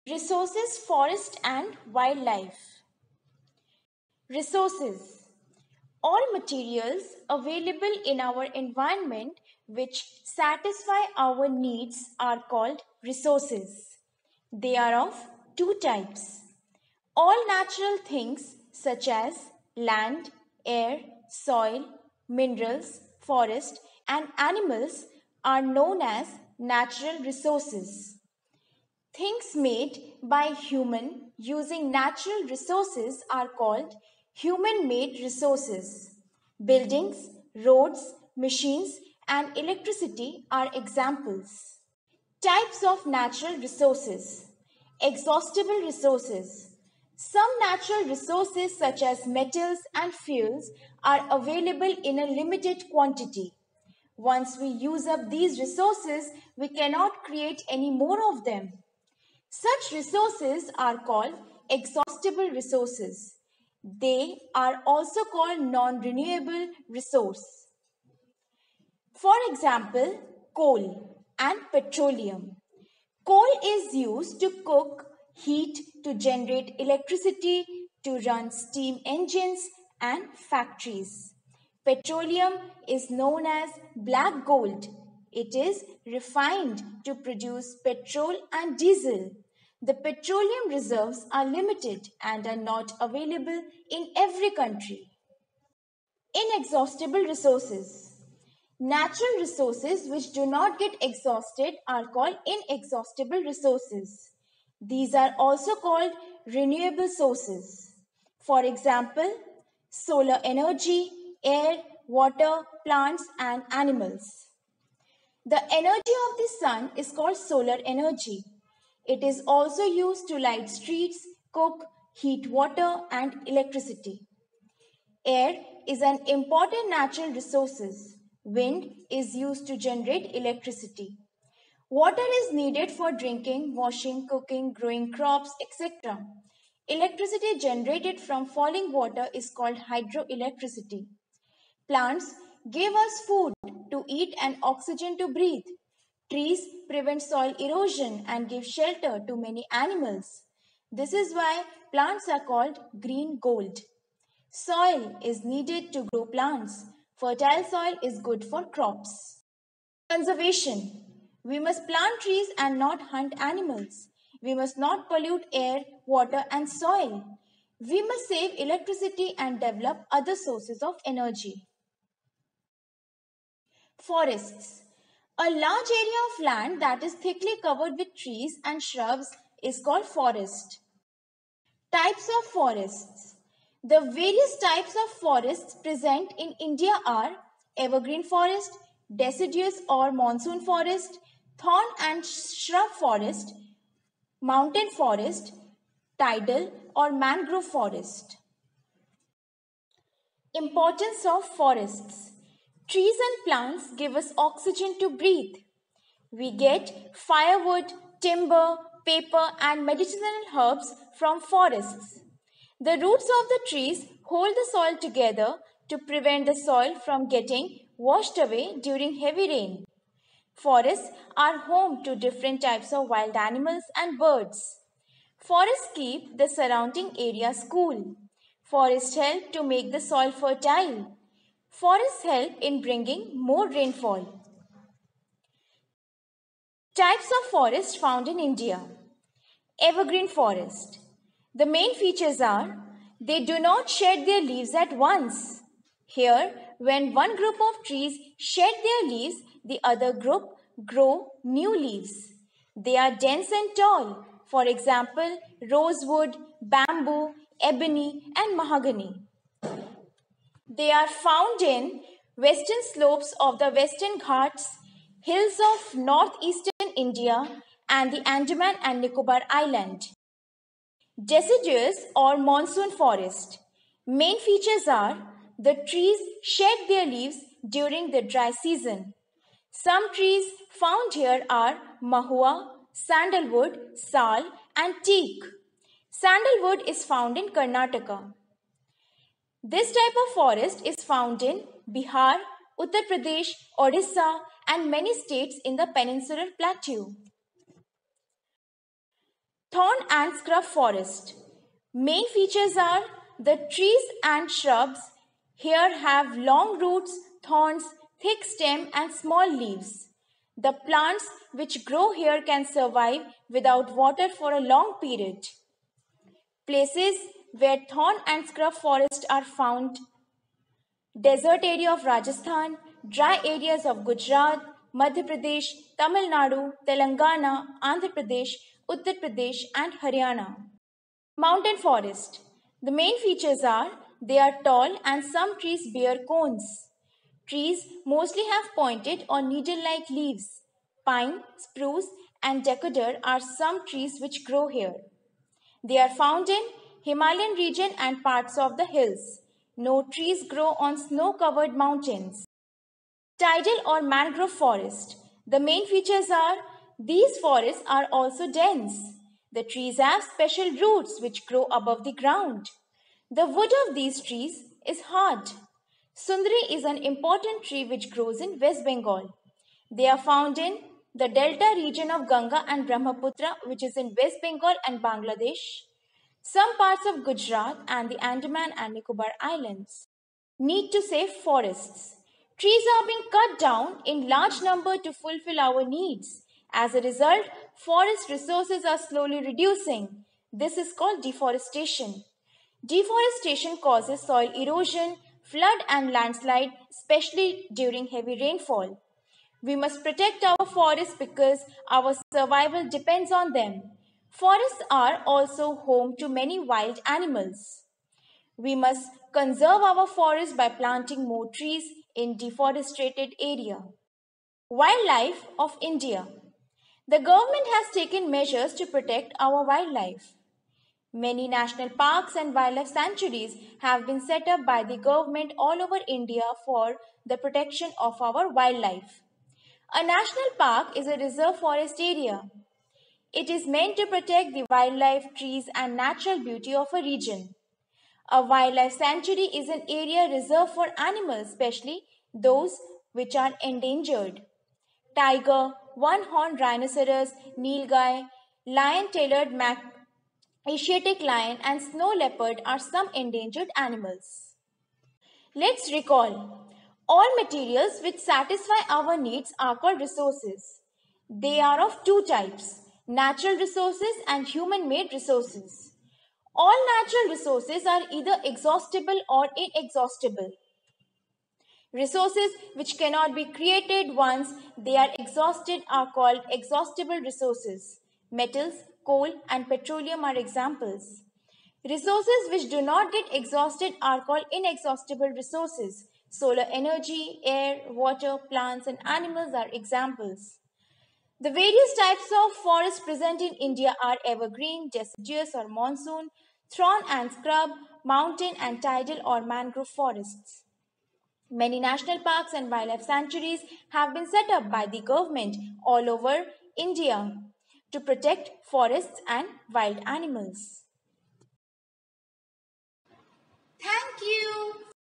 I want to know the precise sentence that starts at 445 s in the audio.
Tiger, one-horned rhinoceros, nilgai, lion-tailed mac Asiatic lion and snow leopard are some endangered animals.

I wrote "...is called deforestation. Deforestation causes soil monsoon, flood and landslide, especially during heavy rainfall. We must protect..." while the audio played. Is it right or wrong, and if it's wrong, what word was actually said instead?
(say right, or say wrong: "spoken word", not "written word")
wrong: "erosion", not "monsoon".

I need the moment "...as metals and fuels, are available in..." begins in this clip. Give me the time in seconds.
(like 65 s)
49 s.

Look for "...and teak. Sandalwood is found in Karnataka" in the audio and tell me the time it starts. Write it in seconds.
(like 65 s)
284 s.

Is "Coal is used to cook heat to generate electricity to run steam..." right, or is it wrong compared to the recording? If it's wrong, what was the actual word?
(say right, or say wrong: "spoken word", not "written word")
right.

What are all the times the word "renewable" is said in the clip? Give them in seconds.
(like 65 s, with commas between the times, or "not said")
65 s, 106 s.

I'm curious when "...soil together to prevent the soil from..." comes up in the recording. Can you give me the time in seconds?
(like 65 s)
214 s.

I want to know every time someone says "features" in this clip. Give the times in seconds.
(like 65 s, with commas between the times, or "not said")
241 s, 274 s, 302 s, 333 s, 355 s.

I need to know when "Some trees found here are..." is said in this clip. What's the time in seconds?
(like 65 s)
279 s.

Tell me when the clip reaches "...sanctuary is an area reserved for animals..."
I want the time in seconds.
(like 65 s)
438 s.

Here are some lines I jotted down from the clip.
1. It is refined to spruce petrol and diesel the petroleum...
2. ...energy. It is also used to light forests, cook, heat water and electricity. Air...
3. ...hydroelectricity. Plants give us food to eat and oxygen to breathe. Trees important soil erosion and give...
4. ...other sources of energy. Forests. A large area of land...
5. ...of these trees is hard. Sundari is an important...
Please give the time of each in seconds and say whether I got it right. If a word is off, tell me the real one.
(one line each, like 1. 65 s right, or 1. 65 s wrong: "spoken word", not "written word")
1. 85 s wrong: "produce", not "spruce"
2. 117 s wrong: "streets", not "forests"
3. 139 s wrong: "prevent", not "important"
4. 170 s right
5. 363 s right.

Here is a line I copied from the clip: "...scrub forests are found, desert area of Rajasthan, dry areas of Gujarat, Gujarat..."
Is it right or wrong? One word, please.
wrong.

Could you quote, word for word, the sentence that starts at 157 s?
Fertile soil is good for crops.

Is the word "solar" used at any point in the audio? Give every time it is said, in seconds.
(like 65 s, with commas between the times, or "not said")
109 s, 117 s, 486 s.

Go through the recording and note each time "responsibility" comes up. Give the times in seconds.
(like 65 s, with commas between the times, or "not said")
not said.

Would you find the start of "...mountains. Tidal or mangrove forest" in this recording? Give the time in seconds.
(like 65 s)
351 s.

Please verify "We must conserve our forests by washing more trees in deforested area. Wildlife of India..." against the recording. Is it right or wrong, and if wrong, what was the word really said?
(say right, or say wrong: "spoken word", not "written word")
wrong: "planting", not "washing".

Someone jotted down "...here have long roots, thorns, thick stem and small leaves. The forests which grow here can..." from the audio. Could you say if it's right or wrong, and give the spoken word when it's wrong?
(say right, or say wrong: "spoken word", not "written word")
wrong: "plants", not "forests".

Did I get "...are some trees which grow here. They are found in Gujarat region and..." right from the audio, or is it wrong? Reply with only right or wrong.
wrong.